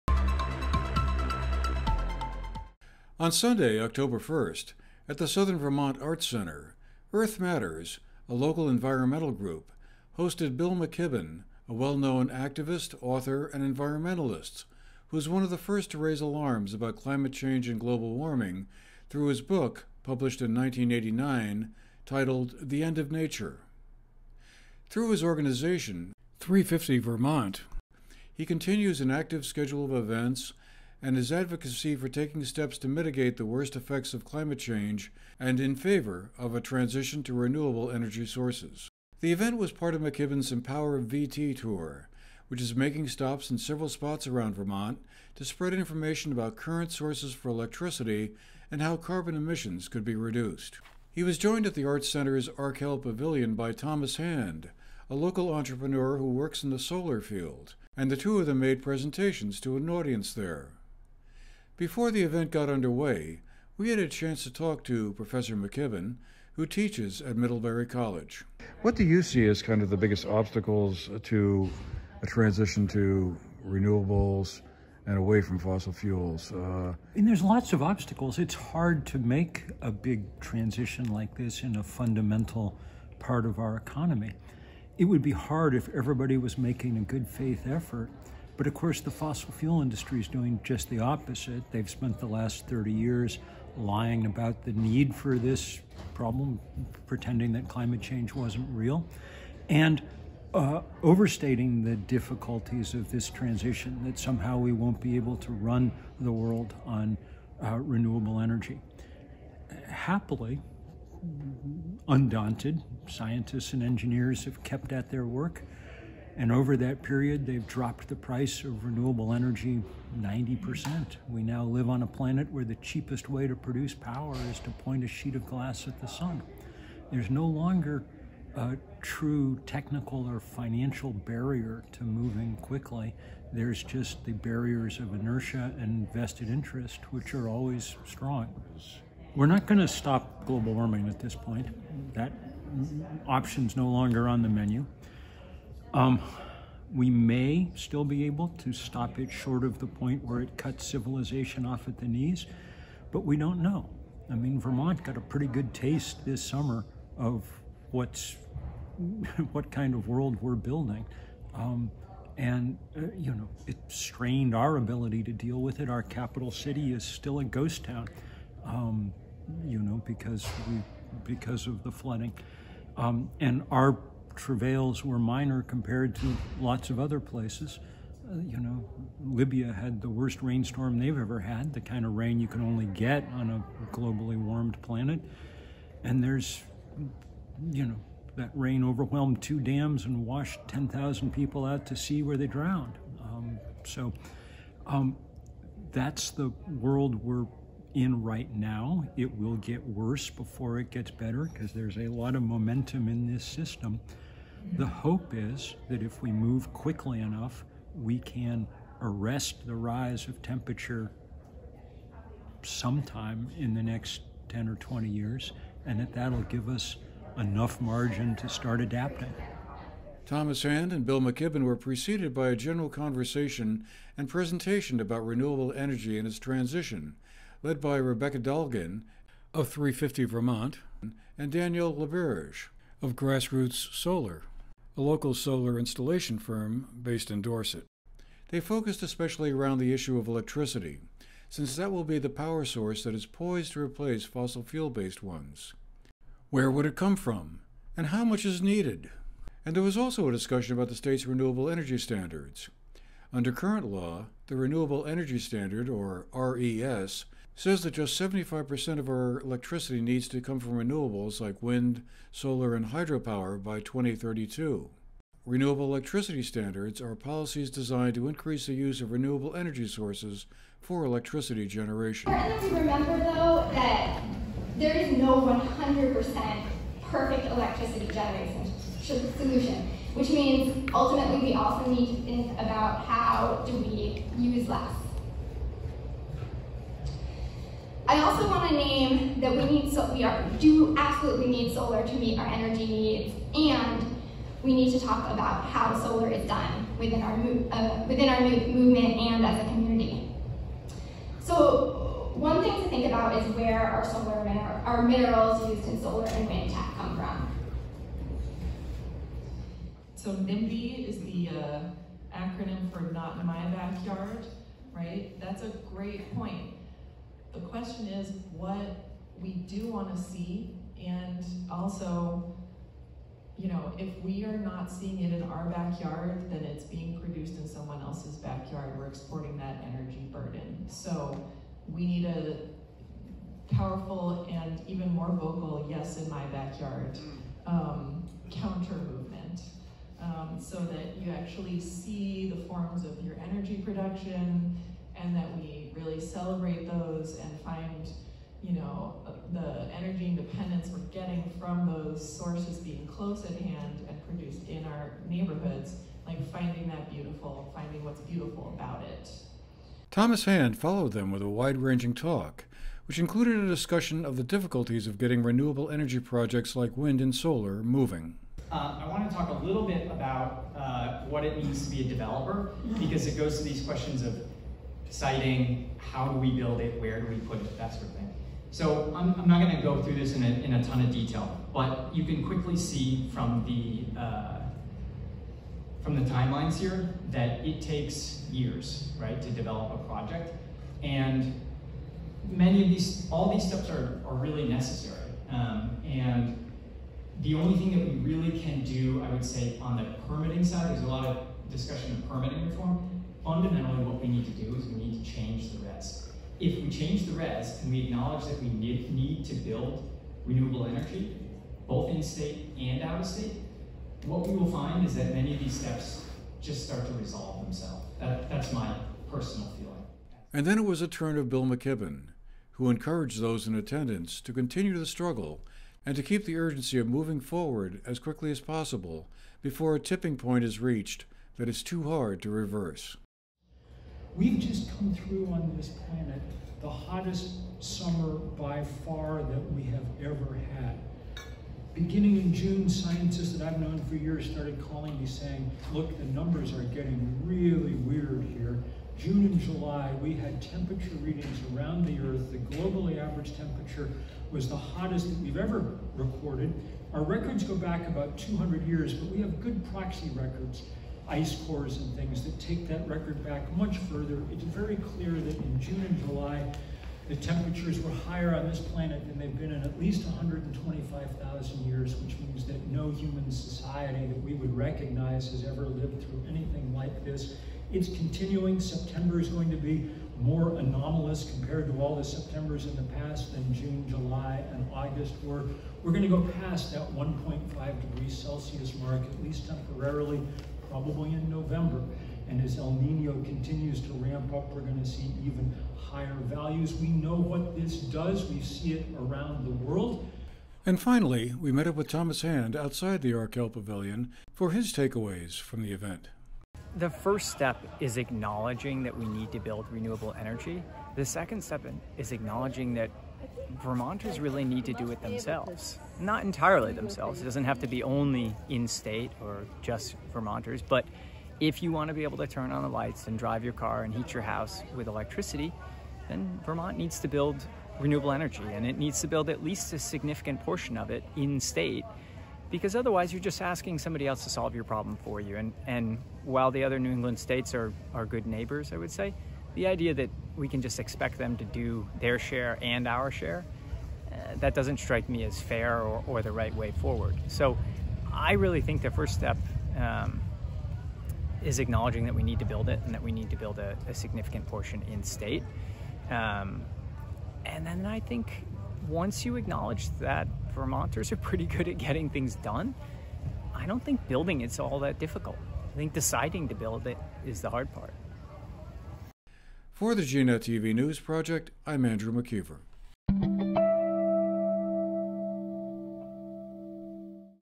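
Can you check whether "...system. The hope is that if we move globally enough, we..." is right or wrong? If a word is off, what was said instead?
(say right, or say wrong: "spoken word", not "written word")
wrong: "quickly", not "globally".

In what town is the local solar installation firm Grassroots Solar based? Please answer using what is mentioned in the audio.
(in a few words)
Dorset.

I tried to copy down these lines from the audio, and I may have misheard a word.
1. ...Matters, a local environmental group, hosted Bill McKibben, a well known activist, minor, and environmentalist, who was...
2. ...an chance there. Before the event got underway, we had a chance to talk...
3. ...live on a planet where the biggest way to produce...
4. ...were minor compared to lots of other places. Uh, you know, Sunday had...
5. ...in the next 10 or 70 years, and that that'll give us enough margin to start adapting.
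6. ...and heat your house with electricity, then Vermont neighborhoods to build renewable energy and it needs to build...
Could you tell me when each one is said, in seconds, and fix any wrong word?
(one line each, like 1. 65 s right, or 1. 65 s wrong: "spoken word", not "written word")
1. 7 s wrong: "author", not "minor"
2. 59 s wrong: "audience", not "chance"
3. 121 s wrong: "cheapest", not "biggest"
4. 175 s wrong: "Libya", not "Sunday"
5. 213 s wrong: "20", not "70"
6. 524 s wrong: "needs", not "neighborhoods".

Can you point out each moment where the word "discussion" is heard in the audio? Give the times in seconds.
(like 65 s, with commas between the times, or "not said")
250 s, 363 s, 401 s.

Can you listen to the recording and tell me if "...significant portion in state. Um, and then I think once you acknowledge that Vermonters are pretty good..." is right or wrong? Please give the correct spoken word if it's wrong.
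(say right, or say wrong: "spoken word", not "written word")
right.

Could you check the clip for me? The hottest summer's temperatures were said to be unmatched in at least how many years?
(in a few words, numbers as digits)
125,000 years.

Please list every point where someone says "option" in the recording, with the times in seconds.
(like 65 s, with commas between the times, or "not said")
143 s.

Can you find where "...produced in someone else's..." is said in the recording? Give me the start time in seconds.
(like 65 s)
327 s.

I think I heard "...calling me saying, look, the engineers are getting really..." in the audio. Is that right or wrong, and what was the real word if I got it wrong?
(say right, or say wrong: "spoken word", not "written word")
wrong: "numbers", not "engineers".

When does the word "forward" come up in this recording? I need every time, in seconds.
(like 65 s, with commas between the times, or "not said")
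427 s, 546 s.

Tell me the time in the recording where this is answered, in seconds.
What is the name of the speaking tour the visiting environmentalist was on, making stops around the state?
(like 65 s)
40 s.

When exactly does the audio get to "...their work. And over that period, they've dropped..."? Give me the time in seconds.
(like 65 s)
115 s.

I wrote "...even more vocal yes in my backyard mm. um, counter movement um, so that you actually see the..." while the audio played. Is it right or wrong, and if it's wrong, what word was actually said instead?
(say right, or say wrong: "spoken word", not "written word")
right.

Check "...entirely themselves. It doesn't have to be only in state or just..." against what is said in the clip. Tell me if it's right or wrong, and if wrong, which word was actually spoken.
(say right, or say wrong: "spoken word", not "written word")
right.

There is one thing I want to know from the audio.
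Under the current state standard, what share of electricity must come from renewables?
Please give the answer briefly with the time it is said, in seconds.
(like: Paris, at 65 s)
75%, at 258 s.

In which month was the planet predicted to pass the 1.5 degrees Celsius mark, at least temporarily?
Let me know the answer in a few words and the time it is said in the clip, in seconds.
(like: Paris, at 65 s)
November, at 491 s.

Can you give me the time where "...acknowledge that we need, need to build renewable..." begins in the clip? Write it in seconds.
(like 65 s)
408 s.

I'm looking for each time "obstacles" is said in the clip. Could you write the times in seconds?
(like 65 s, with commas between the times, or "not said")
70 s, 77 s.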